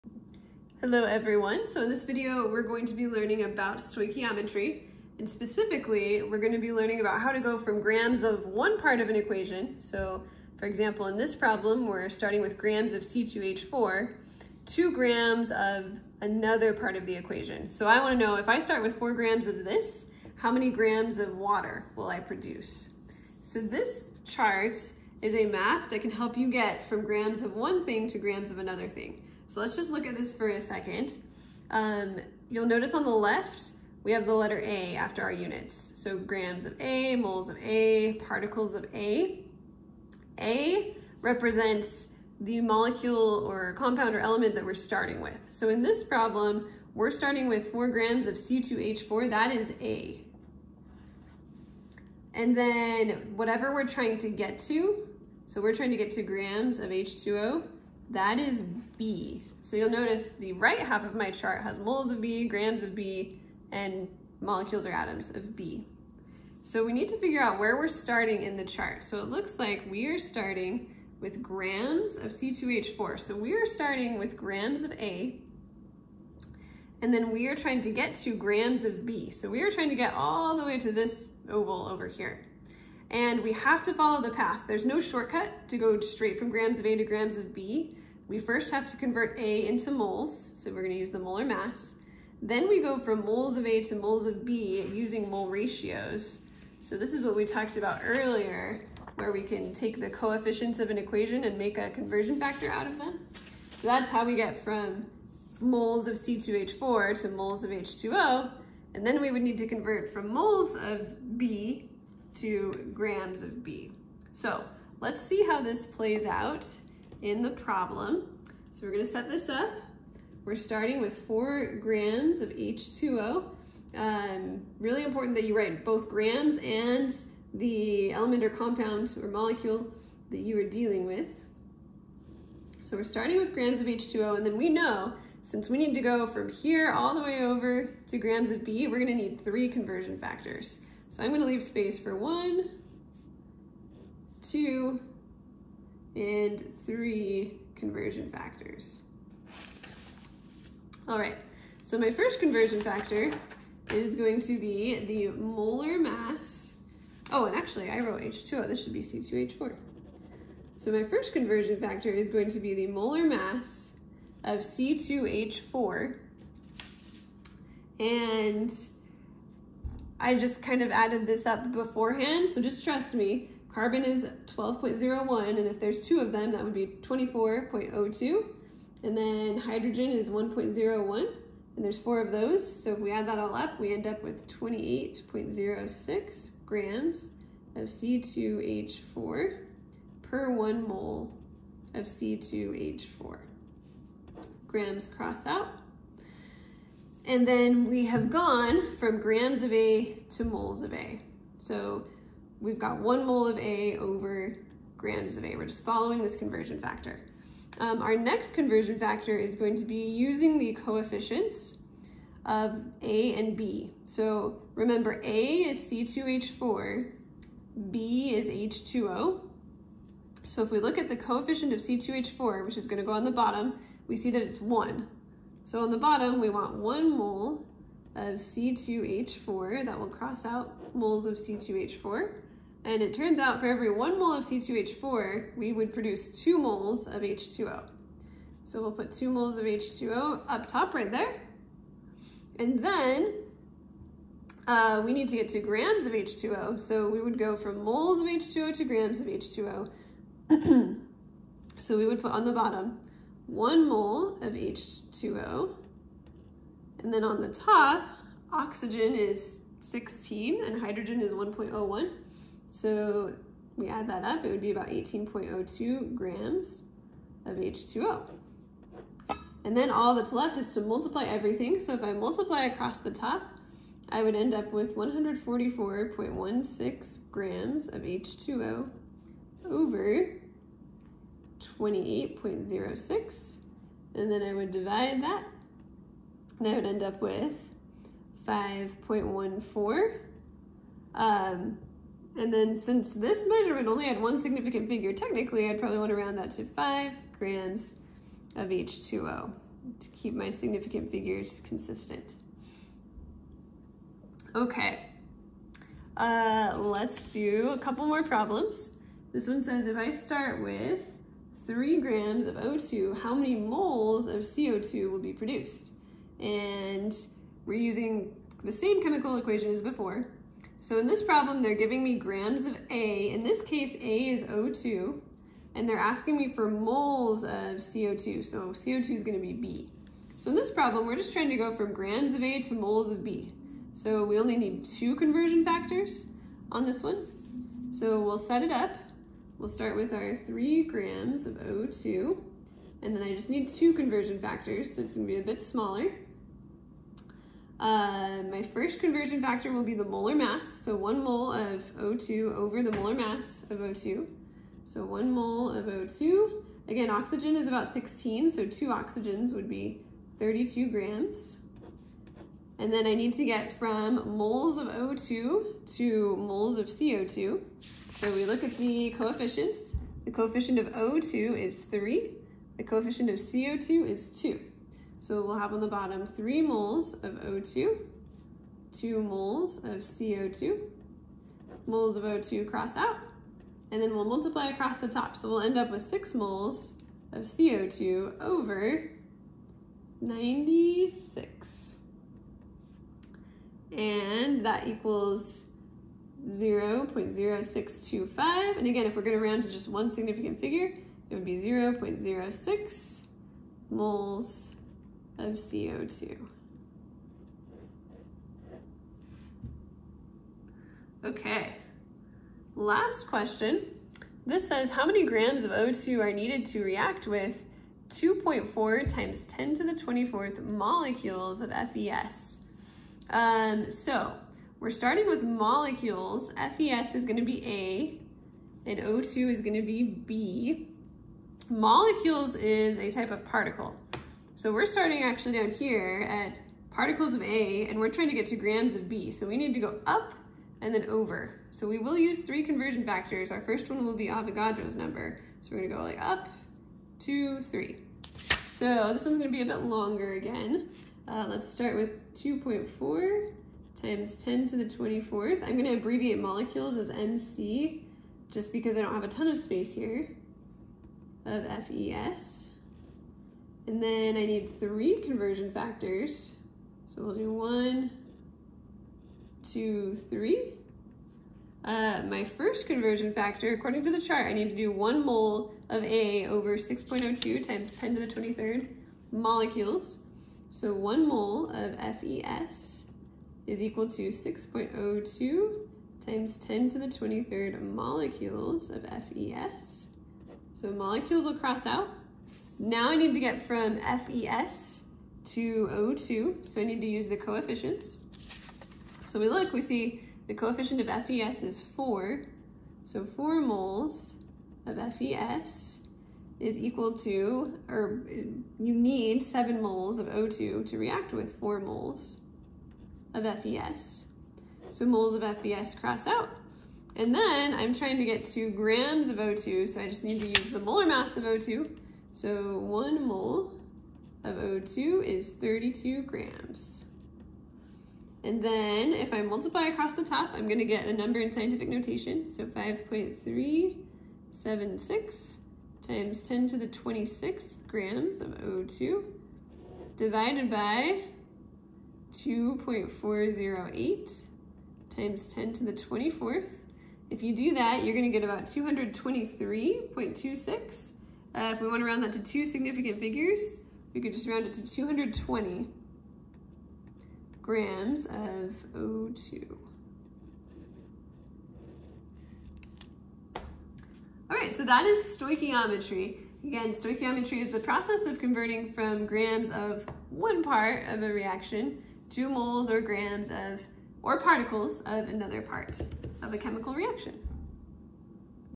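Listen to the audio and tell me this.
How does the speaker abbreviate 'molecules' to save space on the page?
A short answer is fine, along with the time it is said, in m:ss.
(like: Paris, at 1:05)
MC, at 7:37.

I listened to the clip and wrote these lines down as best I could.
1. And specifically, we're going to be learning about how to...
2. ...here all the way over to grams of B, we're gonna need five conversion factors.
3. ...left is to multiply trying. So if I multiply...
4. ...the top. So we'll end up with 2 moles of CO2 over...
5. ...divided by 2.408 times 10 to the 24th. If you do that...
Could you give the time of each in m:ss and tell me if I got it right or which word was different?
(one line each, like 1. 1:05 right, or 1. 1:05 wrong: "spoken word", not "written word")
1. 0:05 right
2. 2:16 wrong: "three", not "five"
3. 4:30 wrong: "everything", not "trying"
4. 6:24 wrong: "6", not "2"
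5. 9:00 right.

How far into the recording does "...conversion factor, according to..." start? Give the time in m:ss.
7:52.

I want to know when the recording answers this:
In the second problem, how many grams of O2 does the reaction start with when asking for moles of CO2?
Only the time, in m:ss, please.
5:11.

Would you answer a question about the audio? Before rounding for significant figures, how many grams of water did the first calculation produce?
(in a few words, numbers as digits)
5.14.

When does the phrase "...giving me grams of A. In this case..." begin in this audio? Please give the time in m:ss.
5:21.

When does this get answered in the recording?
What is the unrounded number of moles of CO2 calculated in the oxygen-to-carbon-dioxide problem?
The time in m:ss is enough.
6:37.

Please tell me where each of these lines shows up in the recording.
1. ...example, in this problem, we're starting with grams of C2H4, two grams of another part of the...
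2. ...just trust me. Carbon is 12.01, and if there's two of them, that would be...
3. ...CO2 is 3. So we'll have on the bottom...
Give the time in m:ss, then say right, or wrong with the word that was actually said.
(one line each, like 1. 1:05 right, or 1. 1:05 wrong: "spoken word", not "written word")
1. 0:10 right
2. 2:52 right
3. 6:13 wrong: "2", not "3".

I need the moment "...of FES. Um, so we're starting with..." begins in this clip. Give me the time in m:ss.
7:01.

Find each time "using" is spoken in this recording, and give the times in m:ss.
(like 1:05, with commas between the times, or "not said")
1:34, 3:30, 5:17.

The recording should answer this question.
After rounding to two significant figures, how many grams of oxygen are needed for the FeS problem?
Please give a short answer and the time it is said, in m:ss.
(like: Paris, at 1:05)
220 grams, at 9:14.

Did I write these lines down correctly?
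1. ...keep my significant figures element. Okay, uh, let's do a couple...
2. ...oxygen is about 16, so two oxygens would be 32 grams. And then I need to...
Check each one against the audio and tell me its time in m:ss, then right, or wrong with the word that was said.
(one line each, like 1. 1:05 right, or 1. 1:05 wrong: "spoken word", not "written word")
1. 5:00 wrong: "consistent", not "element"
2. 5:57 right.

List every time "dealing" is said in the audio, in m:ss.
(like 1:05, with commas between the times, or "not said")
2:10.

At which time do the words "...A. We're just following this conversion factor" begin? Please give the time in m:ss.
3:25.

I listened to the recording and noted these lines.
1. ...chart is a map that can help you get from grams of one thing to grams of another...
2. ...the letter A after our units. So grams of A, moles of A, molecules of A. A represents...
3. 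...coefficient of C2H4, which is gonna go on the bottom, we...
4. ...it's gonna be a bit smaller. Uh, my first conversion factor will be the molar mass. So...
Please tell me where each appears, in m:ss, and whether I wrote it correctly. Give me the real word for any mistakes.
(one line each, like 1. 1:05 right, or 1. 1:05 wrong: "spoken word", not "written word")
1. 0:24 right
2. 0:34 wrong: "particles", not "molecules"
3. 3:41 right
4. 5:45 right.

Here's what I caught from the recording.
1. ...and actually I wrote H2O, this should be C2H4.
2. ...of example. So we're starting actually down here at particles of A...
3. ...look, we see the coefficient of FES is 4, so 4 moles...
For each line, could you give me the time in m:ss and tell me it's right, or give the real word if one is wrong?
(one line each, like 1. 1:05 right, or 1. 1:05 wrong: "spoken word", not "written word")
1. 2:37 right
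2. 7:13 wrong: "particle", not "example"
3. 8:19 right.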